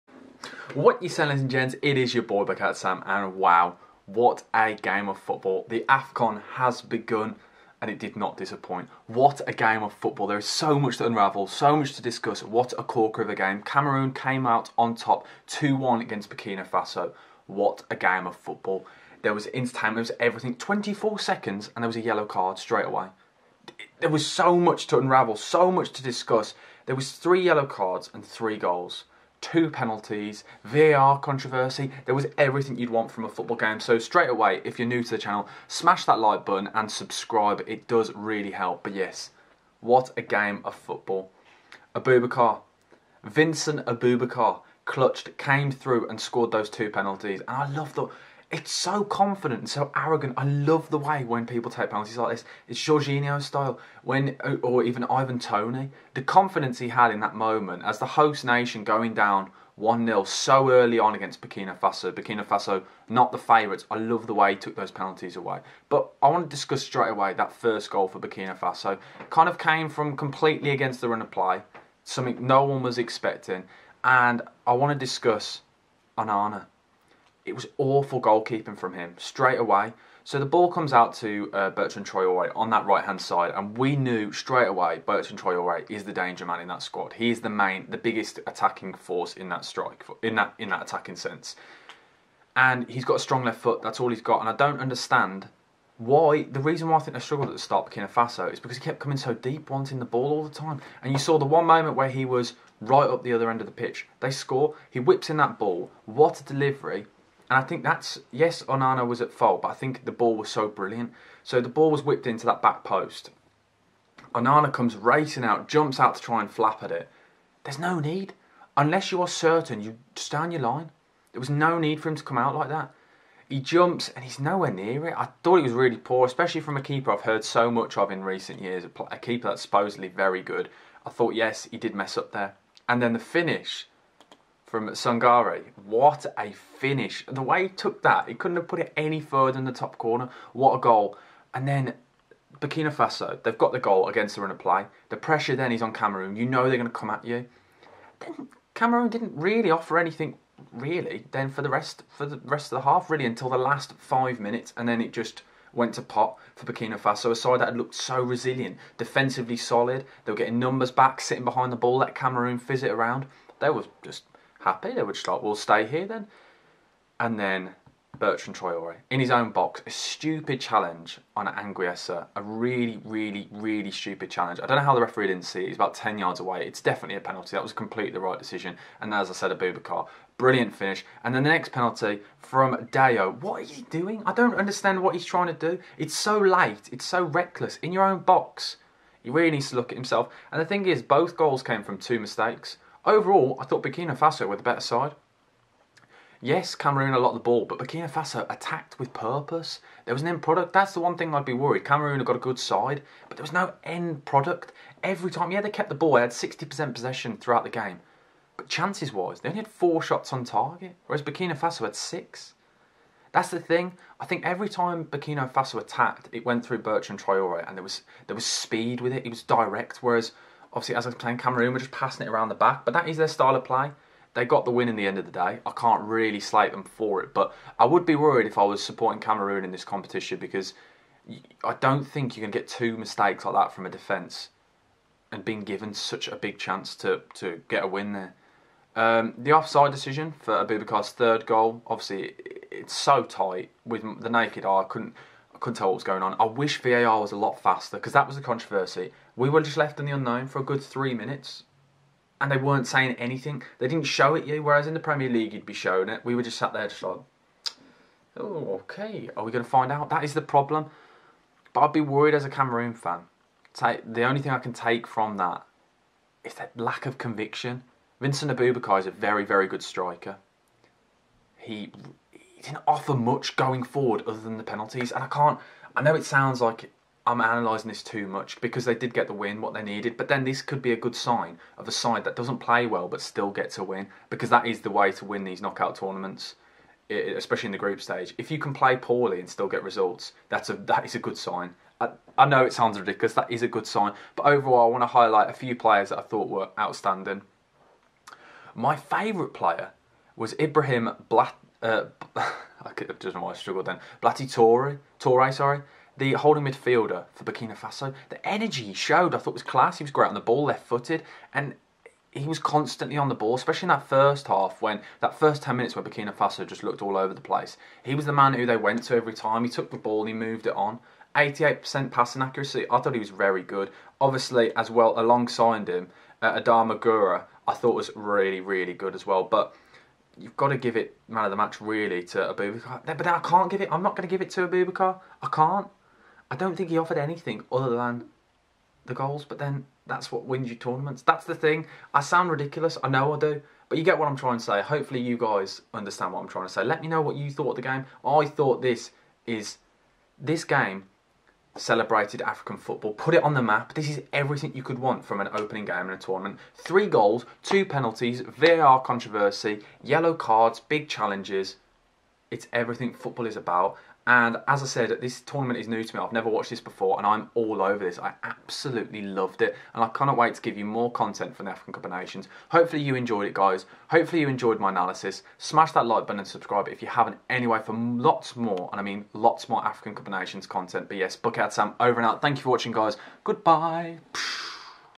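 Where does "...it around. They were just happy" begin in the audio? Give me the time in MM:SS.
02:42.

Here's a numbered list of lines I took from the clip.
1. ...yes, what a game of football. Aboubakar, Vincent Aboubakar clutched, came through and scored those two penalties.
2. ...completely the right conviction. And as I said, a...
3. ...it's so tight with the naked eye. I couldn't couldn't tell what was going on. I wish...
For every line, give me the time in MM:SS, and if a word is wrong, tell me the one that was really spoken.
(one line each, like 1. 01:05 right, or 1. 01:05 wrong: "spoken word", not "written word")
1. 00:38 right
2. 02:57 wrong: "decision", not "conviction"
3. 04:02 right.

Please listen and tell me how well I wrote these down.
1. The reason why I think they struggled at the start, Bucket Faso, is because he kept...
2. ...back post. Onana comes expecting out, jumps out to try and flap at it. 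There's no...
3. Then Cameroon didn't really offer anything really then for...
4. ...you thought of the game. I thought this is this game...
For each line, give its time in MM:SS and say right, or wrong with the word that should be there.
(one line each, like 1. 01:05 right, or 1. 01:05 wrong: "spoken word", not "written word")
1. 01:36 wrong: "Burkina", not "Bucket"
2. 01:52 wrong: "racing", not "expecting"
3. 02:28 right
4. 05:47 right.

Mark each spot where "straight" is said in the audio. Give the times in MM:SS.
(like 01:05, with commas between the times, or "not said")
00:22, 00:33, 01:06, 01:19, 01:24.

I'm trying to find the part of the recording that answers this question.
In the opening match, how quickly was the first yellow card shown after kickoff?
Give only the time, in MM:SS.
00:20.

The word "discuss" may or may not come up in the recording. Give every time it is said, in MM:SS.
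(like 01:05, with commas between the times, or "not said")
00:12, 00:26, 01:06, 01:15.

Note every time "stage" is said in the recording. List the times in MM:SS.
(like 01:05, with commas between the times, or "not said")
04:48.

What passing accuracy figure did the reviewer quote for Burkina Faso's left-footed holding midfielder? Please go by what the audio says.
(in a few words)
88%.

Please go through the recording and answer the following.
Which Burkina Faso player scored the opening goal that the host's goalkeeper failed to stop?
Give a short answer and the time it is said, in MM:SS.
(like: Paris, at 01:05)
Sangare, at 02:14.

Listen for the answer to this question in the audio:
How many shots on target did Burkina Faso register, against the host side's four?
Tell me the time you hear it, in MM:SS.
03:31.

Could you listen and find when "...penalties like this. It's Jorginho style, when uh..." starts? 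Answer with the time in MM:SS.
00:51.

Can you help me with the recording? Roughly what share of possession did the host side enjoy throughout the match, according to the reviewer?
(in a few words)
60%.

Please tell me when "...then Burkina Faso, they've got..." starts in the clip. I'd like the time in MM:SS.
02:21.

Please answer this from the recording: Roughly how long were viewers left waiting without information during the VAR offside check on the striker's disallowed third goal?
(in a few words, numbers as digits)
3 minutes.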